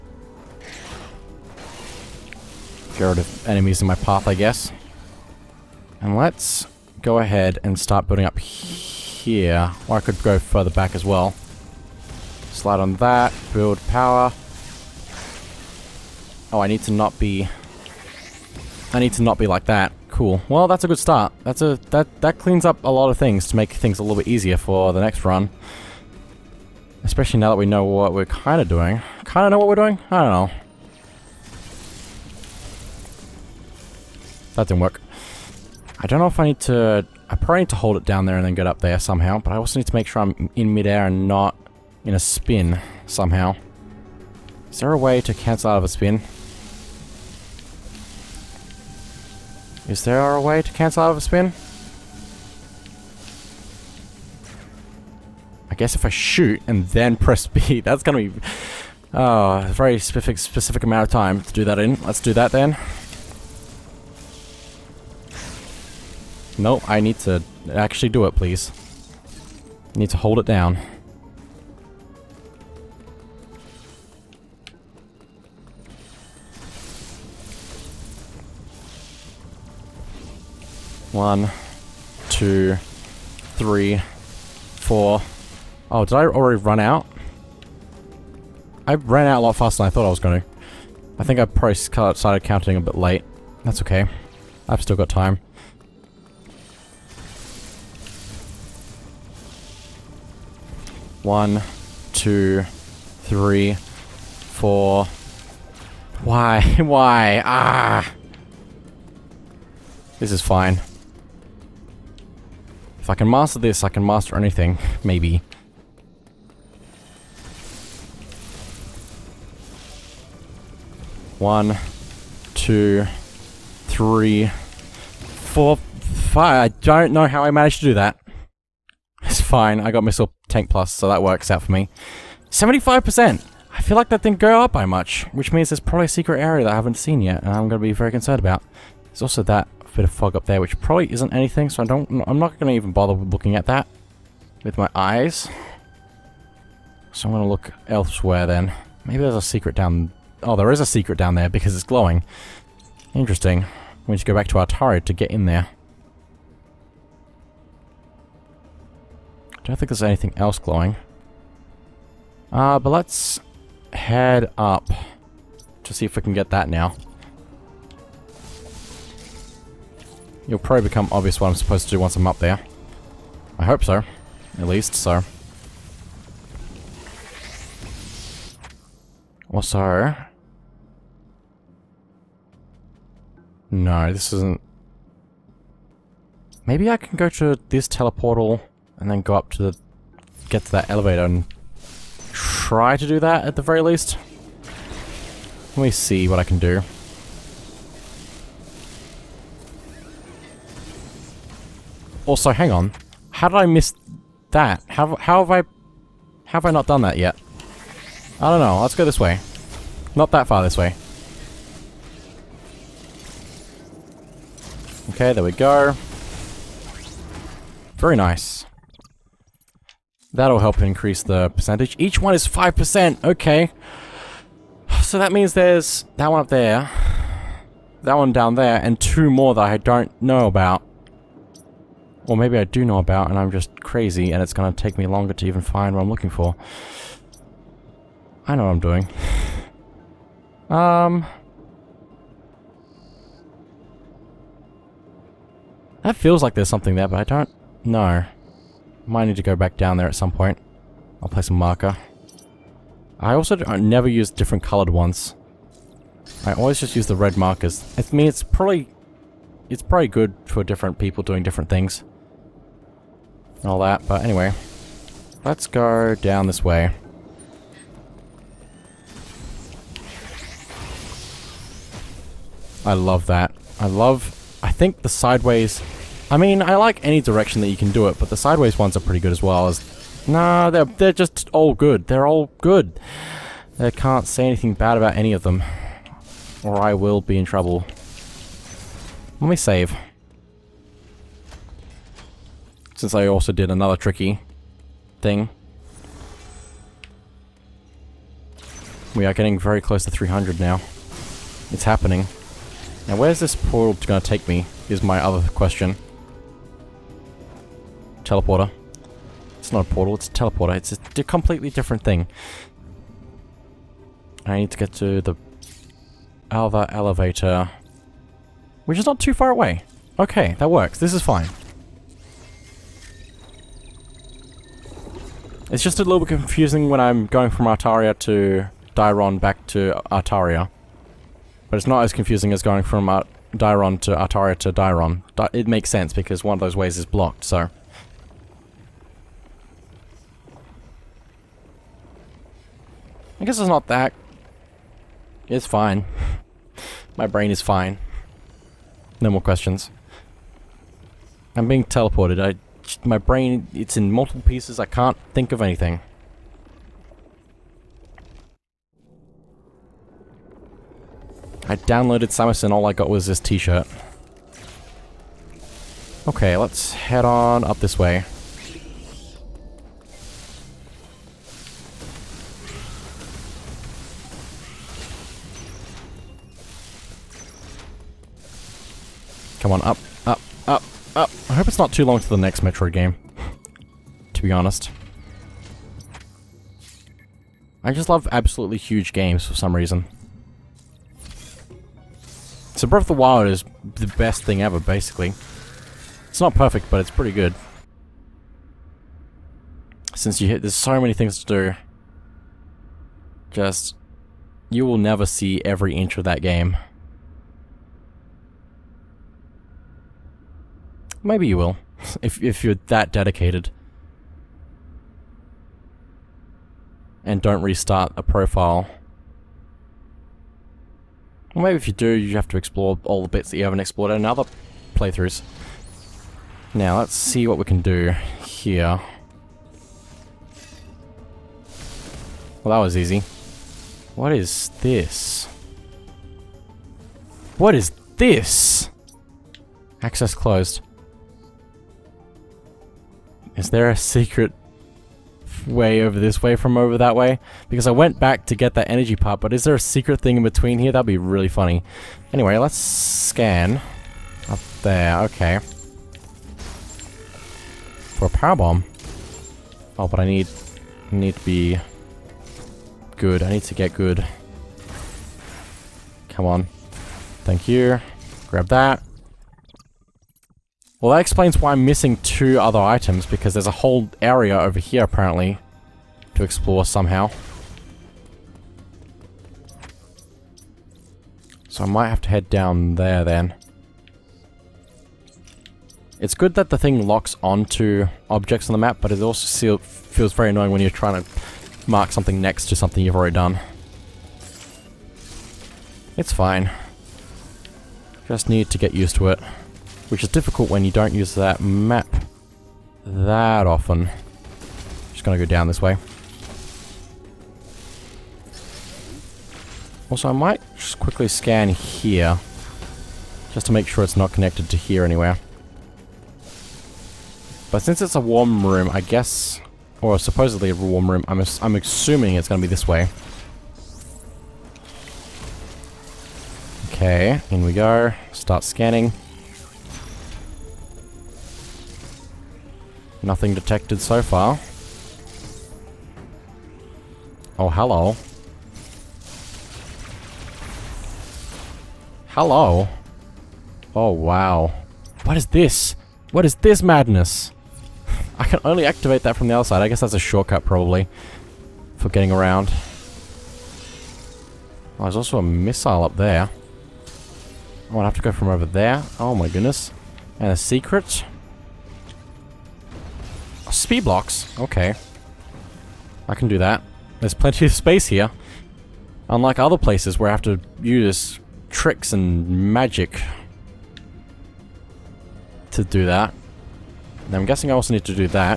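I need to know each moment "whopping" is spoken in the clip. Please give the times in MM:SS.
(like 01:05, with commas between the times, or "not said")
not said.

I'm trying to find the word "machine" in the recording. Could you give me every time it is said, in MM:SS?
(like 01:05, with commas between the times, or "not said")
not said.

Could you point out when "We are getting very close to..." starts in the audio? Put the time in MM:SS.
04:59.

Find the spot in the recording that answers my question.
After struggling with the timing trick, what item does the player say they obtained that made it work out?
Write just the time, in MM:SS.
02:10.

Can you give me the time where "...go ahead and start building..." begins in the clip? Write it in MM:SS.
00:07.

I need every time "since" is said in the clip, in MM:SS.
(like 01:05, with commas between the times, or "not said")
04:52, 06:40, 08:37.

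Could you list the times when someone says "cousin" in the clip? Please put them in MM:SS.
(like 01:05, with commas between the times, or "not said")
not said.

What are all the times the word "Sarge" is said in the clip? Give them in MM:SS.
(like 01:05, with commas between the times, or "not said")
not said.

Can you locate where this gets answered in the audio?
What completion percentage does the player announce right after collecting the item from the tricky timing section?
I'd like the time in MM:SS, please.
02:12.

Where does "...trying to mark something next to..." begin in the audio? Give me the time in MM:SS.
08:10.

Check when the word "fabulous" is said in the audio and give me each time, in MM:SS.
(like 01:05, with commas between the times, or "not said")
not said.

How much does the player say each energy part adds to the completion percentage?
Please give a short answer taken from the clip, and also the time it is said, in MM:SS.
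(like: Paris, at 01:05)
5%, at 03:42.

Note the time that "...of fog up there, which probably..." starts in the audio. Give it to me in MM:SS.
02:20.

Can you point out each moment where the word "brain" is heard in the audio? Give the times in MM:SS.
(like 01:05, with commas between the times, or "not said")
05:47, 05:53.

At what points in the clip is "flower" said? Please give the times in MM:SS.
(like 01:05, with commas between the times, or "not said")
not said.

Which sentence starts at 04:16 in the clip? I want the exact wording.
I always just use the red markers.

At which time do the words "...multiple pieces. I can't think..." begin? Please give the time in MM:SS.
05:54.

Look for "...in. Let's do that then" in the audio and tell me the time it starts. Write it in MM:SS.
01:01.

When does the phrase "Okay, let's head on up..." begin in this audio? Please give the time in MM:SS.
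06:06.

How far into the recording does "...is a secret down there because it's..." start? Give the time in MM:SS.
02:30.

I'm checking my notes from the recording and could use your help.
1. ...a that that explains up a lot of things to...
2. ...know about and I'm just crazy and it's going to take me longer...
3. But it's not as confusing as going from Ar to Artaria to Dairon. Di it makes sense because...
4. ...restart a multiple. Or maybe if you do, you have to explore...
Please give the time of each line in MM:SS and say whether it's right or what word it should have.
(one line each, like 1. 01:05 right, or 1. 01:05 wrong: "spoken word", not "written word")
1. 00:21 wrong: "cleans", not "explains"
2. 03:52 right
3. 05:31 right
4. 06:57 wrong: "profile", not "multiple".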